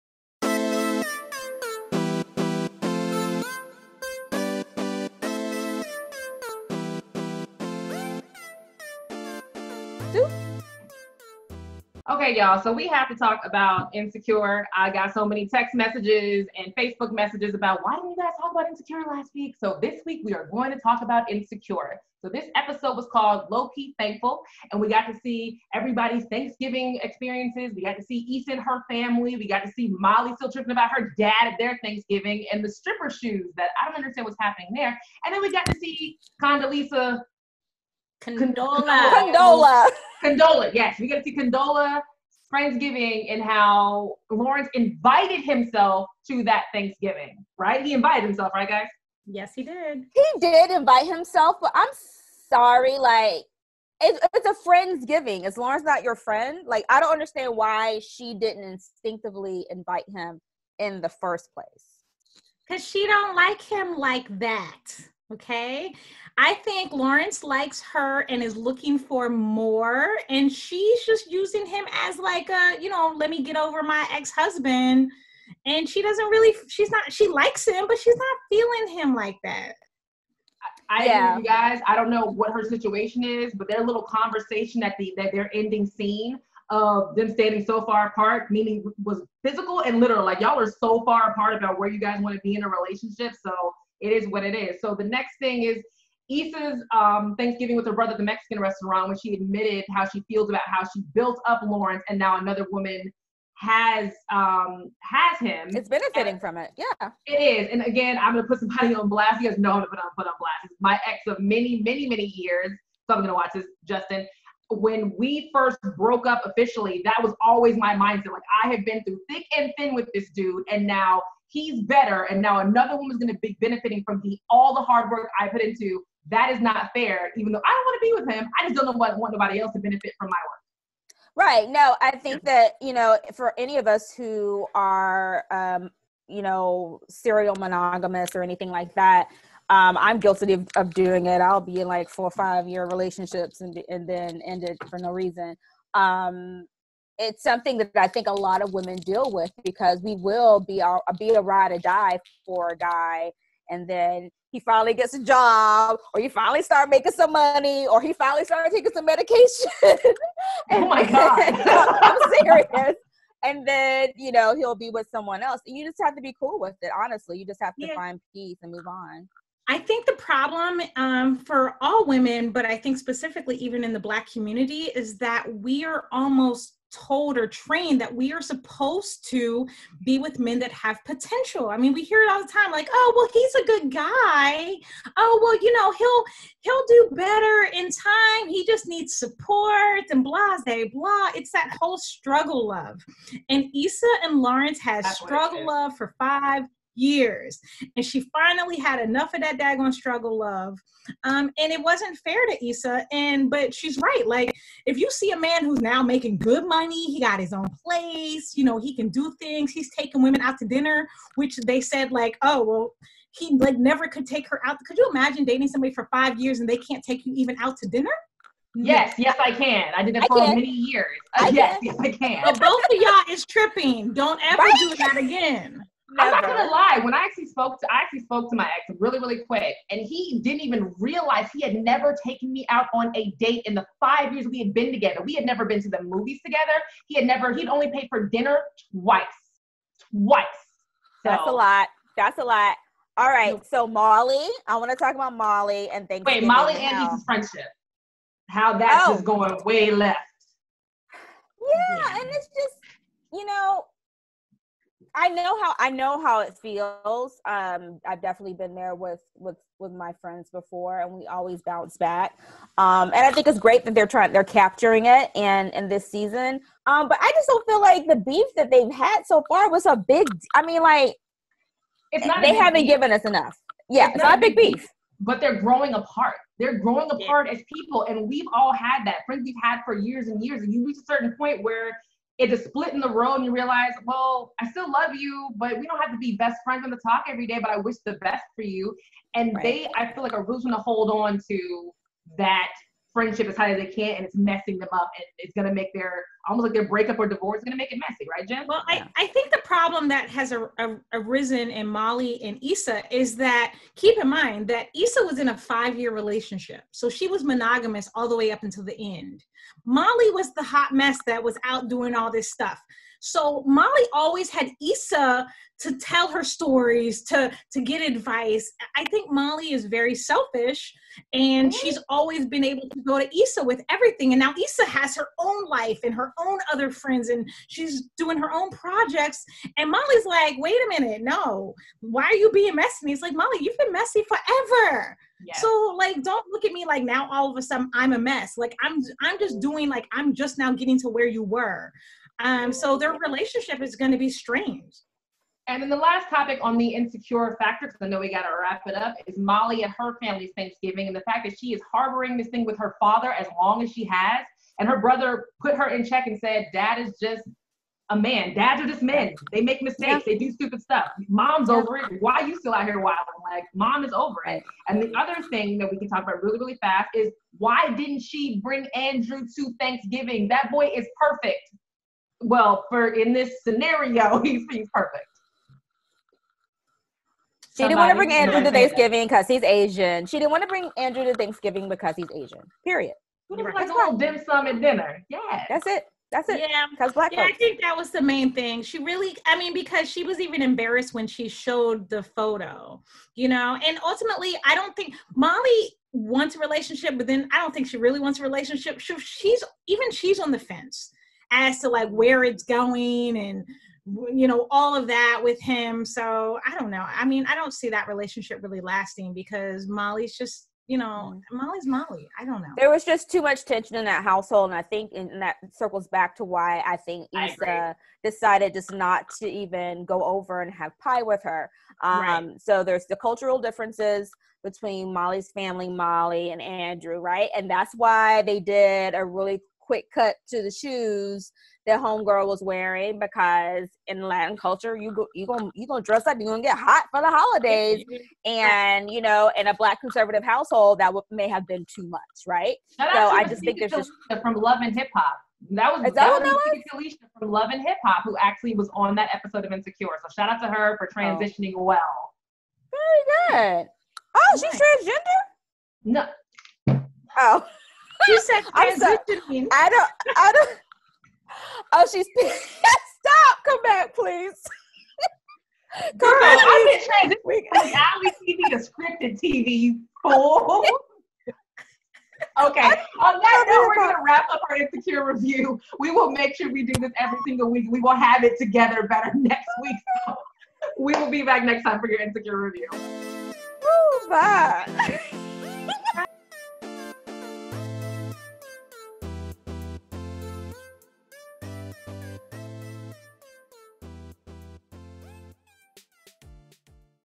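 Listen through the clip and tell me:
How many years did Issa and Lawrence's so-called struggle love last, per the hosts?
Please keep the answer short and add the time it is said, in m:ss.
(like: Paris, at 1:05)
5, at 3:16.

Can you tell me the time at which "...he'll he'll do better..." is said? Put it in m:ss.
3:05.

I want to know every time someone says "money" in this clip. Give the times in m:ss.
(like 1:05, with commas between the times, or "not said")
2:37, 3:26.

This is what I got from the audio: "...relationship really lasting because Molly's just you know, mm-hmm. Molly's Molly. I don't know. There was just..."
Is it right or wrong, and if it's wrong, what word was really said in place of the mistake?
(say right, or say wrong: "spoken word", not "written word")
right.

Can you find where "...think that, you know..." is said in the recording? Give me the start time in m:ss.
2:12.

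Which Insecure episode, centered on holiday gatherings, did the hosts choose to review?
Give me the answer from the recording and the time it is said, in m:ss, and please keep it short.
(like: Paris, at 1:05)
Low Key Thankful, at 0:23.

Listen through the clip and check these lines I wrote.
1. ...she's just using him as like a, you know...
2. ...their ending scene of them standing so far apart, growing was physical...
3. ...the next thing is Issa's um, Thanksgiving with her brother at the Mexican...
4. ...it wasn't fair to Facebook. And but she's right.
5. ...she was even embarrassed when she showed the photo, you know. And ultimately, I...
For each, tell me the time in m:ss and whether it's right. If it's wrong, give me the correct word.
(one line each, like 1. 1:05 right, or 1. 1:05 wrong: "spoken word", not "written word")
1. 1:10 right
2. 1:25 wrong: "meaning", not "growing"
3. 1:34 right
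4. 3:21 wrong: "Issa", not "Facebook"
5. 6:30 right.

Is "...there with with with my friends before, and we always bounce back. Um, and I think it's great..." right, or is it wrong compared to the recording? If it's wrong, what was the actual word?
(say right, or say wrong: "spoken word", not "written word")
right.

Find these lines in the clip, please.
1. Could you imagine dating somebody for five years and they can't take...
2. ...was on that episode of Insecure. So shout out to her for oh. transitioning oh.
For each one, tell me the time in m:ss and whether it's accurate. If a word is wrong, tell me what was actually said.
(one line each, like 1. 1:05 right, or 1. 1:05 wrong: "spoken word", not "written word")
1. 3:34 right
2. 7:28 right.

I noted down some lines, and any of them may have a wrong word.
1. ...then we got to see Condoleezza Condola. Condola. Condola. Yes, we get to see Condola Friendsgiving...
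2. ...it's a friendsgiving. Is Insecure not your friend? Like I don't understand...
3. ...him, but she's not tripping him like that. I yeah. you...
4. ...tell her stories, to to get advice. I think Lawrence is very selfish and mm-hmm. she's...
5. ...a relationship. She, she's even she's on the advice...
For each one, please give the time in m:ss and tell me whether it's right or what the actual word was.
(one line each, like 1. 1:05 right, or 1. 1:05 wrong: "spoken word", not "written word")
1. 0:35 right
2. 0:54 wrong: "Lawrence", not "Insecure"
3. 1:17 wrong: "feeling", not "tripping"
4. 5:15 wrong: "Molly", not "Lawrence"
5. 6:38 wrong: "fence", not "advice".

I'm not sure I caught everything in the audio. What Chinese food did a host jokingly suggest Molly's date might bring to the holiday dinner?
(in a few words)
dim sum.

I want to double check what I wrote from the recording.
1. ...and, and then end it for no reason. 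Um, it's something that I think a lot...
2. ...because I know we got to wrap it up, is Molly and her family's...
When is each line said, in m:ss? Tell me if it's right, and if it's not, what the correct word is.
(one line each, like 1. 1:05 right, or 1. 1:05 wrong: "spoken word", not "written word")
1. 2:23 right
2. 5:47 right.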